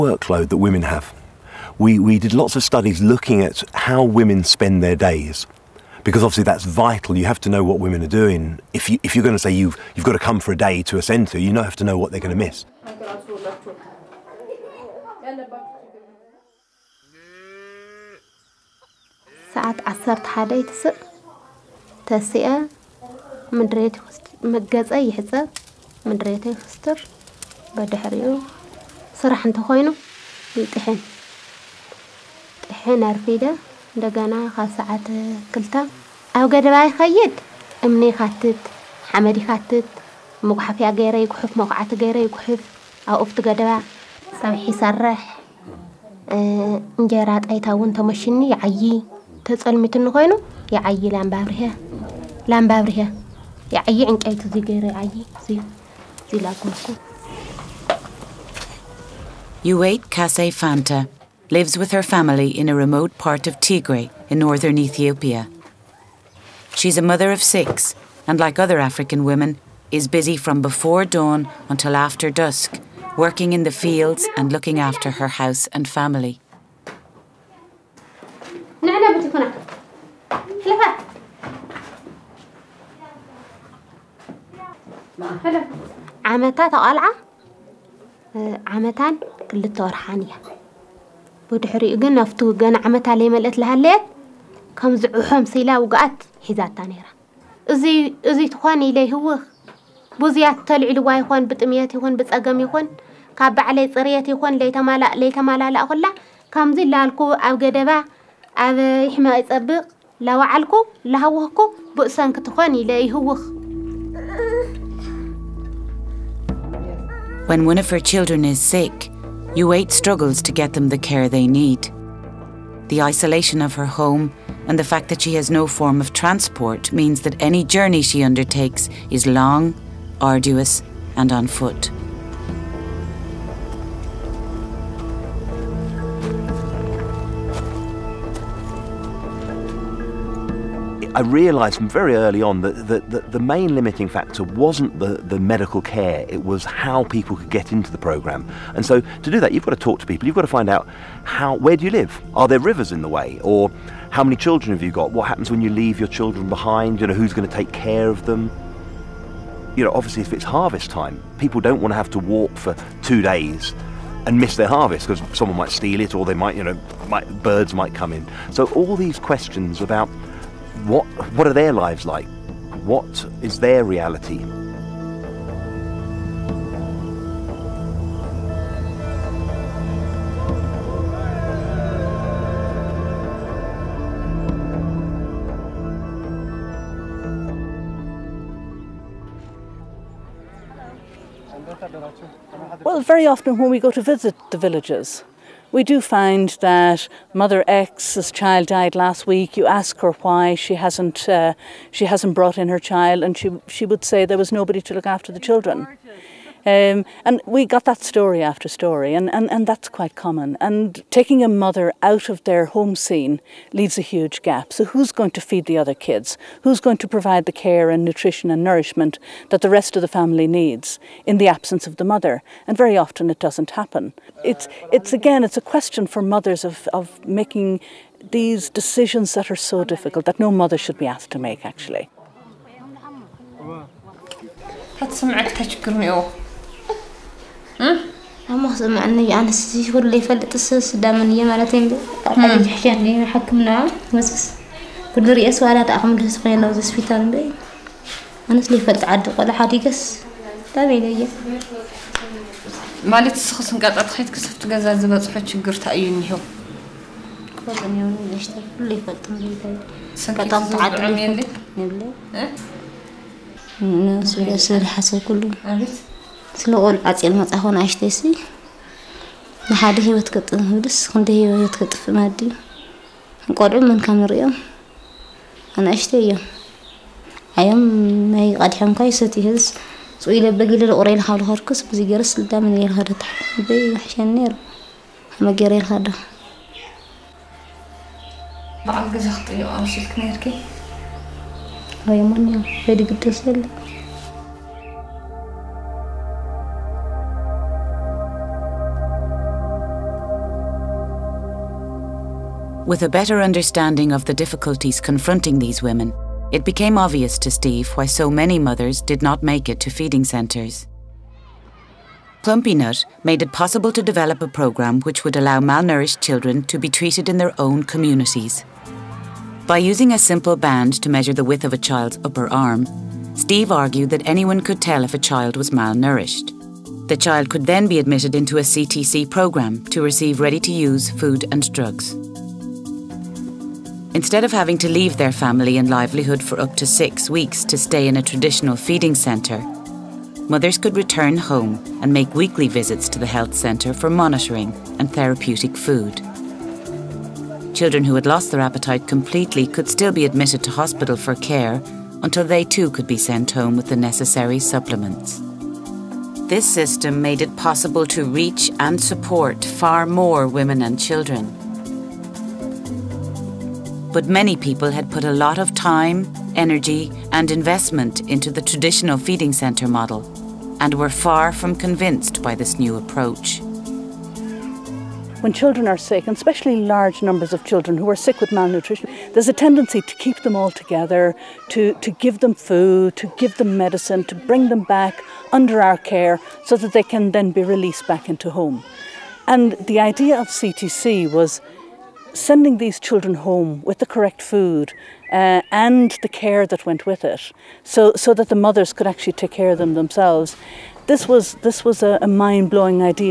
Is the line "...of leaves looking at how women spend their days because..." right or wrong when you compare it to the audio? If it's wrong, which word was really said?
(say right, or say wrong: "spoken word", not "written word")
wrong: "studies", not "leaves".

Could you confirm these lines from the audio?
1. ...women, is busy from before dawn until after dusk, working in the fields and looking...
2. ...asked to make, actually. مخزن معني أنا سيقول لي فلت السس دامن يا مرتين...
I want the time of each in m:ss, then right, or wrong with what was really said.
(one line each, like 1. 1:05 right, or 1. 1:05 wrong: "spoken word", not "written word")
1. 1:09 right
2. 3:51 right.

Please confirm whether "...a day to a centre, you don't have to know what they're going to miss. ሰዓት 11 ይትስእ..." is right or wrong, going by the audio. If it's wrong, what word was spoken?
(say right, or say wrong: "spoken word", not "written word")
right.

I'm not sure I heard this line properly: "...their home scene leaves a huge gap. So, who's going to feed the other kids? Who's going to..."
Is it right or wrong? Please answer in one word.
right.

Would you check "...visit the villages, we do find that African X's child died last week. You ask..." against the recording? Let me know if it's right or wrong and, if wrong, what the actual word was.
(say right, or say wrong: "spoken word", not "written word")
wrong: "Mother", not "African".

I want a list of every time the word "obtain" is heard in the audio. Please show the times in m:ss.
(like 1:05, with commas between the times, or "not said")
not said.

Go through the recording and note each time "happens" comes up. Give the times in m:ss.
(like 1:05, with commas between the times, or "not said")
2:35, 3:43.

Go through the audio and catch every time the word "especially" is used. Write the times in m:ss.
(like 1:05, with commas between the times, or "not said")
6:16.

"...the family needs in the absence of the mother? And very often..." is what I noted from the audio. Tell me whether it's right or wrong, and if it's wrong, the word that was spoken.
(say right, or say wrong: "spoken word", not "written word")
right.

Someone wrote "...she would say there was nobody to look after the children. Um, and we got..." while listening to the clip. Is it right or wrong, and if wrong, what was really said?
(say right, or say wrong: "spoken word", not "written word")
right.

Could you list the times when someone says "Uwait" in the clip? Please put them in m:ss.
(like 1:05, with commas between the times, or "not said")
0:59, 1:59.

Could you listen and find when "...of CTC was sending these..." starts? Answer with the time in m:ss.
6:30.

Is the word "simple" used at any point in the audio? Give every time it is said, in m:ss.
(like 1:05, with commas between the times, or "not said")
5:20.